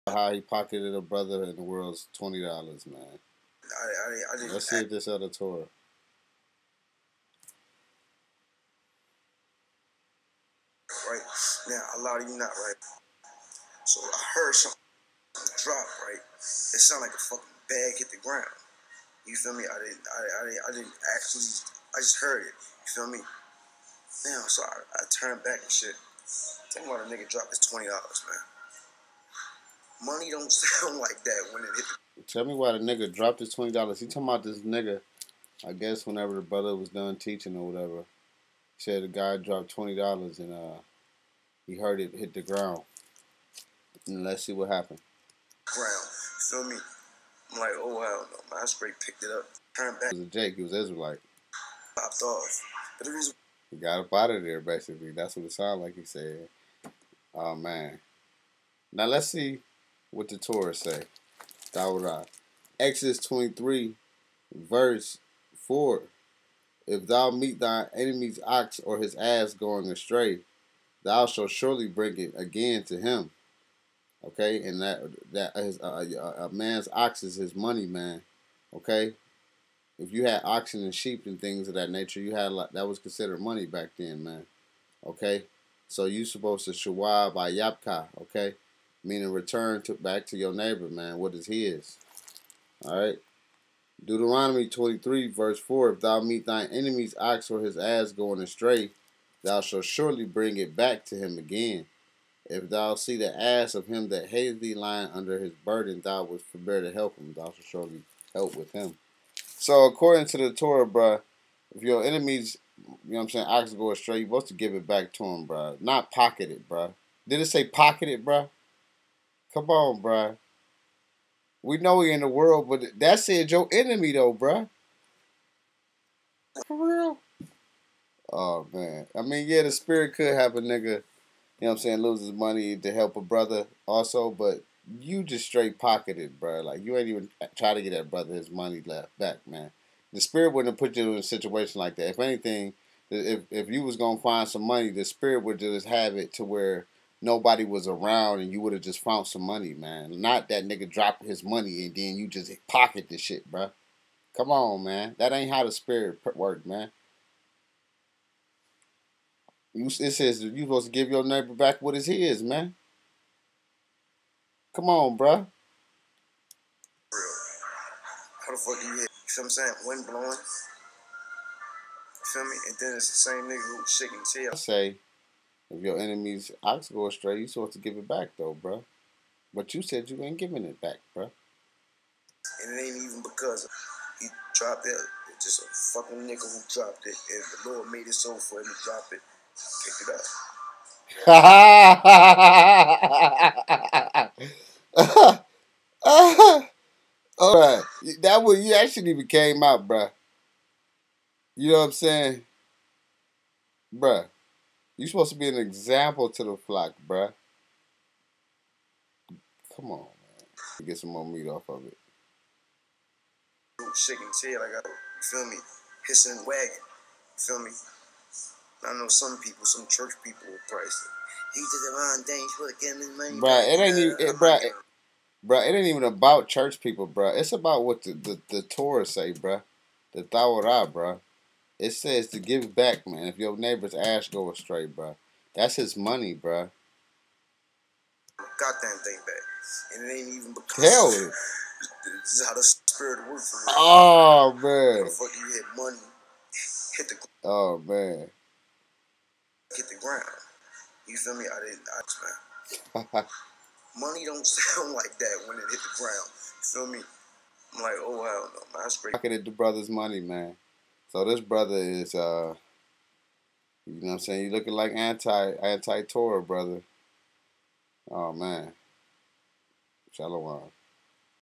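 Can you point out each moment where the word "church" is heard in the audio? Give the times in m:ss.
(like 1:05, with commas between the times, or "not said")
3:39, 3:46.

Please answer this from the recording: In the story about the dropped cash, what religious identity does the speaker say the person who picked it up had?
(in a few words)
Israelite.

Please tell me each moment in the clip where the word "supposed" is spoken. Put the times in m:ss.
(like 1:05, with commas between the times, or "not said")
1:26, 1:54, 2:40, 2:57, 3:25.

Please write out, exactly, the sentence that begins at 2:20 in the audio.
The spirit wouldn't have put you in a situation like that.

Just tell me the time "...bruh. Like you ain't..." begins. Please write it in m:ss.
2:16.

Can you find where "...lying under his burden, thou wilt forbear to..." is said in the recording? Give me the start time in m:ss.
1:44.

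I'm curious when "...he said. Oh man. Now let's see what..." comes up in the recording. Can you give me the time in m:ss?
0:55.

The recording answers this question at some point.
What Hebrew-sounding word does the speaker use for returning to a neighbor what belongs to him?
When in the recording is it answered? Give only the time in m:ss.
1:26.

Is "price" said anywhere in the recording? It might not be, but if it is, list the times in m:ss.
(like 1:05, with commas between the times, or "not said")
3:40.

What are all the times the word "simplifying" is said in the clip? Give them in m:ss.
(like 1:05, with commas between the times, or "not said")
not said.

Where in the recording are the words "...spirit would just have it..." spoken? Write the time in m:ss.
2:25.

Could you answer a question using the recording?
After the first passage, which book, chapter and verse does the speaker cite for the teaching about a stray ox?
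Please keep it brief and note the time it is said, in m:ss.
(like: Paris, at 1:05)
Deuteronomy 23:4, at 1:34.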